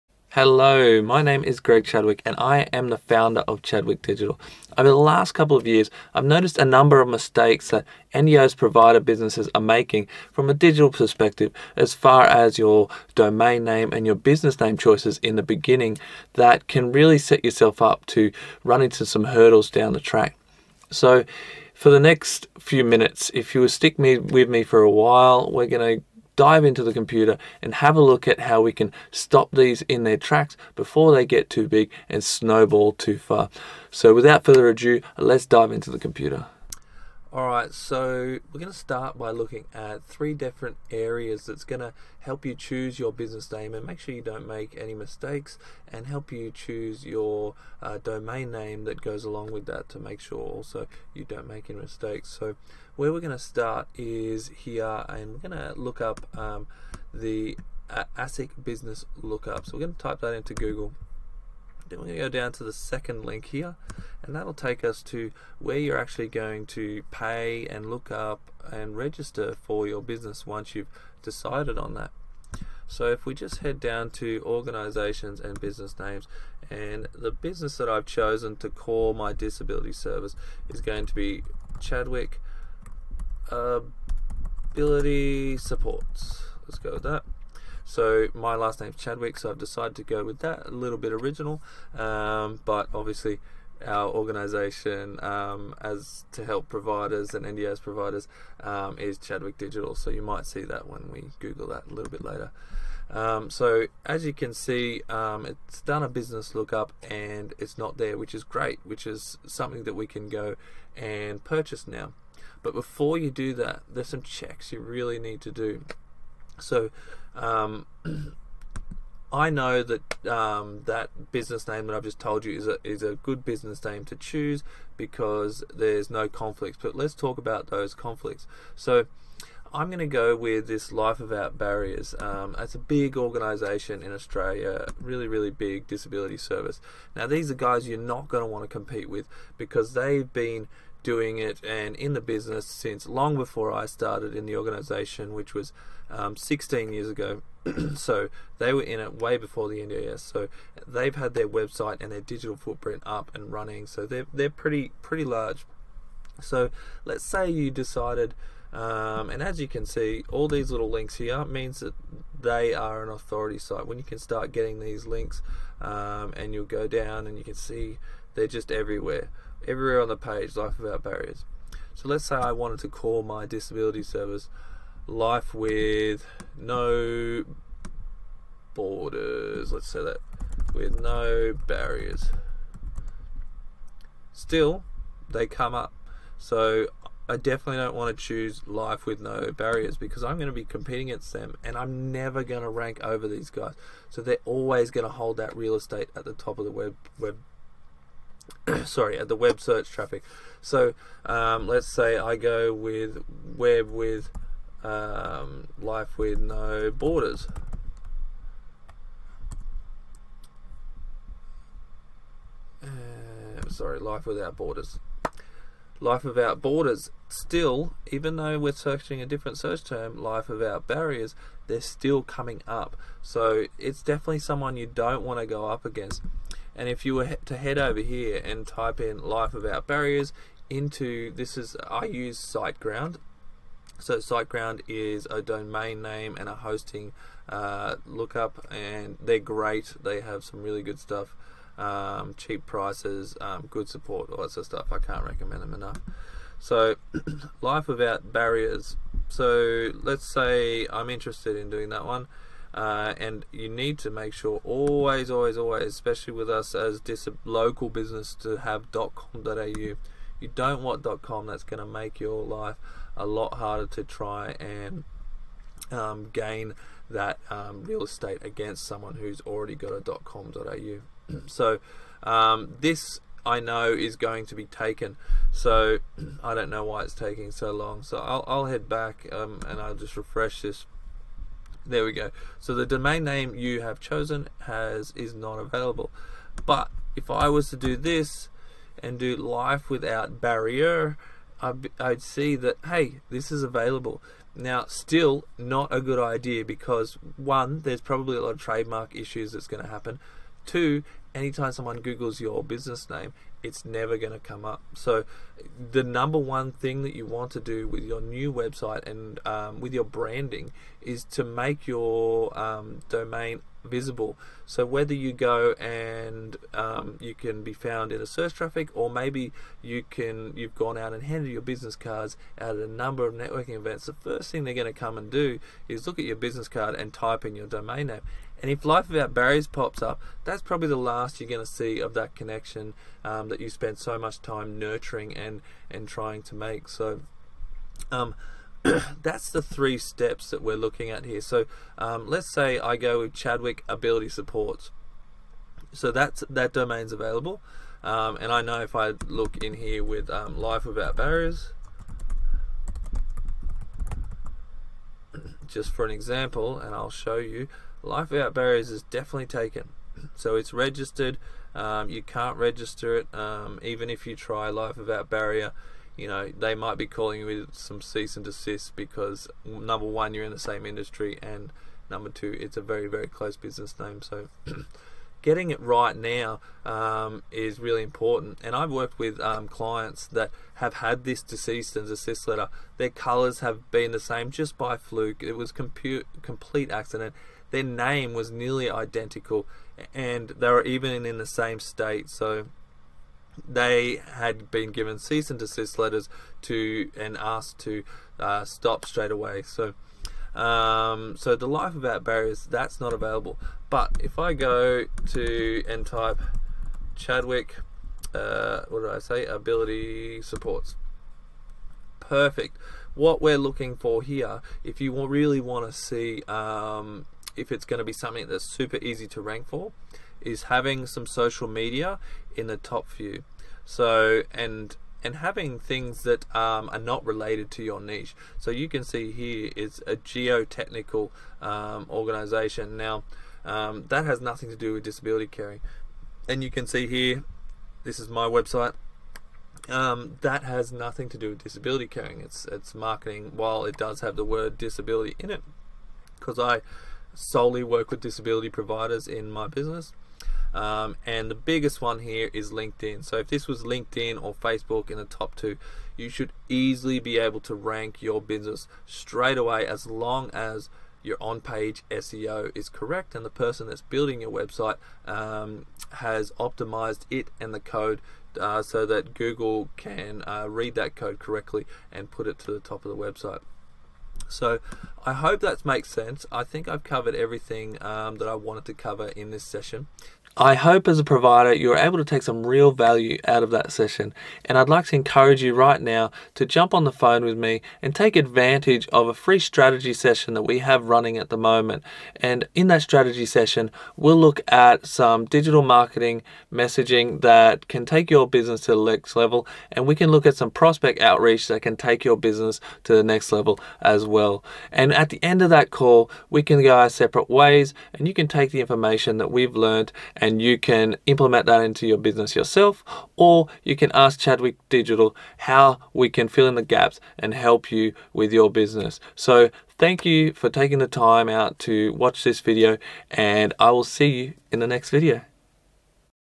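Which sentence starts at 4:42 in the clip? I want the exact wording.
So the domain name you have chosen has is not available.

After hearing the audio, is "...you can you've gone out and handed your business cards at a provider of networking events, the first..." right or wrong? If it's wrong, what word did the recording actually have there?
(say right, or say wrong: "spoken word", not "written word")
wrong: "number", not "provider".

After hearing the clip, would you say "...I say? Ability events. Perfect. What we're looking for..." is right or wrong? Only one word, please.
wrong.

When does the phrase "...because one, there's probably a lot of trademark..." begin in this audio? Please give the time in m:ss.
4:56.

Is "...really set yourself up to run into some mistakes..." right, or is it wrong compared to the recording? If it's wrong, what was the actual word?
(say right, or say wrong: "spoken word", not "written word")
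wrong: "hurdles", not "mistakes".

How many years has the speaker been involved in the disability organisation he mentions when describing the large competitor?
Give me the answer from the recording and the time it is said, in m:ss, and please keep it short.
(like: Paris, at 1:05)
16, at 2:26.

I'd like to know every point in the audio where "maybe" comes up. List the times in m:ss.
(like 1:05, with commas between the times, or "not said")
5:19.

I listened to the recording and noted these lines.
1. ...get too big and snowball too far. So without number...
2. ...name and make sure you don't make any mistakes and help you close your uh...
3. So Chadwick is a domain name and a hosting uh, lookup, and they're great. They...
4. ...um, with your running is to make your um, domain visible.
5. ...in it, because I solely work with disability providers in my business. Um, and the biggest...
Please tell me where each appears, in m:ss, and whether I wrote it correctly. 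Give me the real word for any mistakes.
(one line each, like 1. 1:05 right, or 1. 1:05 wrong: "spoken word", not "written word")
1. 0:31 wrong: "further", not "number"
2. 0:43 wrong: "choose", not "close"
3. 3:53 wrong: "SiteGround", not "Chadwick"
4. 5:09 wrong: "branding", not "running"
5. 7:25 right.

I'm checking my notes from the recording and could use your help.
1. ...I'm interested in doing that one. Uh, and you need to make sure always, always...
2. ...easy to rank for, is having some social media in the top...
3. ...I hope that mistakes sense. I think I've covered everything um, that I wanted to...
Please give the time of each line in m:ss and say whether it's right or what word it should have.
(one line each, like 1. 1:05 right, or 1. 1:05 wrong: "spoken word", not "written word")
1. 4:10 right
2. 6:59 right
3. 7:55 wrong: "makes", not "mistakes".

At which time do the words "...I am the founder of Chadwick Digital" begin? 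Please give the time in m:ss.
0:02.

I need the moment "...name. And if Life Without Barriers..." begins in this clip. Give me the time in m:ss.
5:28.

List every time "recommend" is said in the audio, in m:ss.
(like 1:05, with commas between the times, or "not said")
4:05.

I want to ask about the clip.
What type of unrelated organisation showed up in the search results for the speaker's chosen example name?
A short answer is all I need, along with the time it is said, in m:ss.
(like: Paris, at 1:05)
geotechnical, at 7:10.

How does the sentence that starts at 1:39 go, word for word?
So you might see that when we Google that a little bit later.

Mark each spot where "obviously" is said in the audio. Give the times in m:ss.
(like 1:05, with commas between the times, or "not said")
1:32.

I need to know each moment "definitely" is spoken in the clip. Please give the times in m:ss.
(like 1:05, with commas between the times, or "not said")
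3:07, 3:44, 5:59.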